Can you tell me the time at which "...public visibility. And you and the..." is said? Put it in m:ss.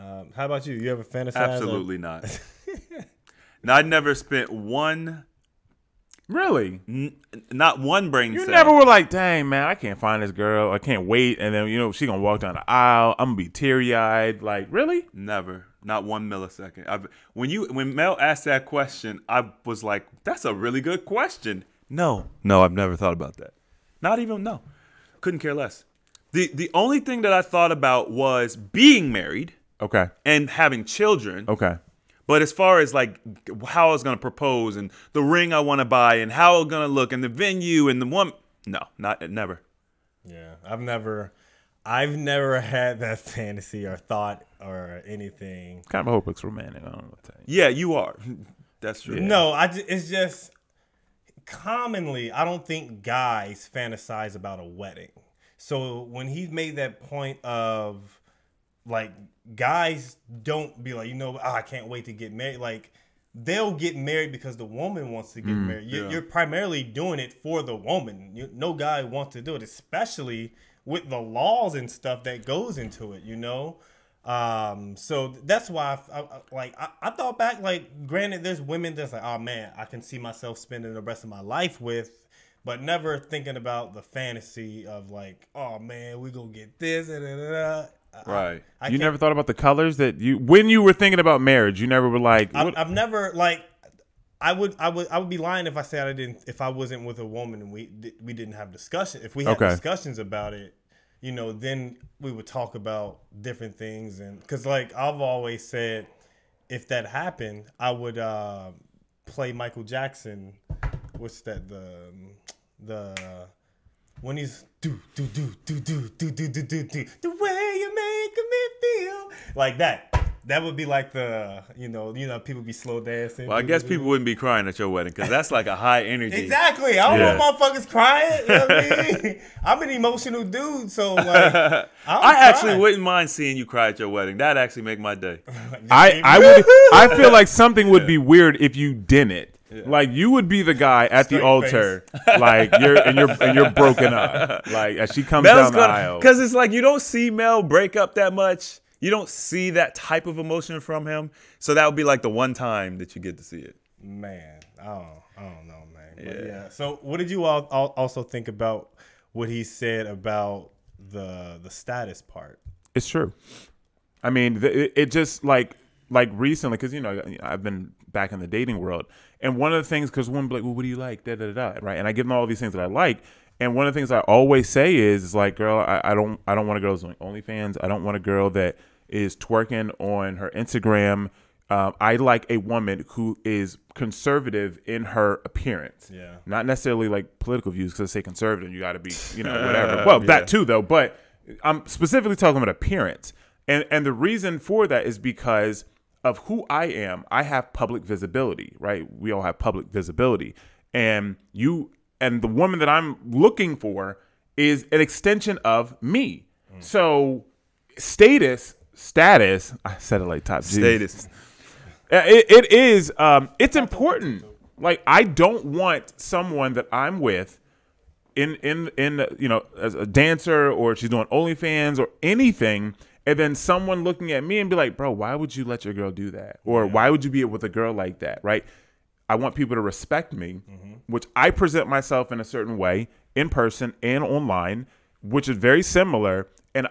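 3:19.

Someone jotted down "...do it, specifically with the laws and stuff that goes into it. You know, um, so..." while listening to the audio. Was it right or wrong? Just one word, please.
wrong.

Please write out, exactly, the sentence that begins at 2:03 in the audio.
Well, I guess people wouldn't be crying at your wedding because that's like a high energy.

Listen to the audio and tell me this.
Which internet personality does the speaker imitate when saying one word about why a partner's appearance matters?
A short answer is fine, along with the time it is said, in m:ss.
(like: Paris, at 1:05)
Top G, at 3:30.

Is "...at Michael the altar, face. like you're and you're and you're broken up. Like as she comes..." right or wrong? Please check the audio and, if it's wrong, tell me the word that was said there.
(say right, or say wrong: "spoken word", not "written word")
wrong: "Straight", not "Michael".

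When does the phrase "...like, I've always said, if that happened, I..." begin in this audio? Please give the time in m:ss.
1:44.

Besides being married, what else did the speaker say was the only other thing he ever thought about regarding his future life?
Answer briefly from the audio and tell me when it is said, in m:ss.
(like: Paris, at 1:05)
having children, at 0:30.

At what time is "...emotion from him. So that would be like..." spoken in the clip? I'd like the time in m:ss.
2:30.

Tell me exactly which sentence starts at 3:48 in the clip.
Right I want people to respect me, mm-hmm.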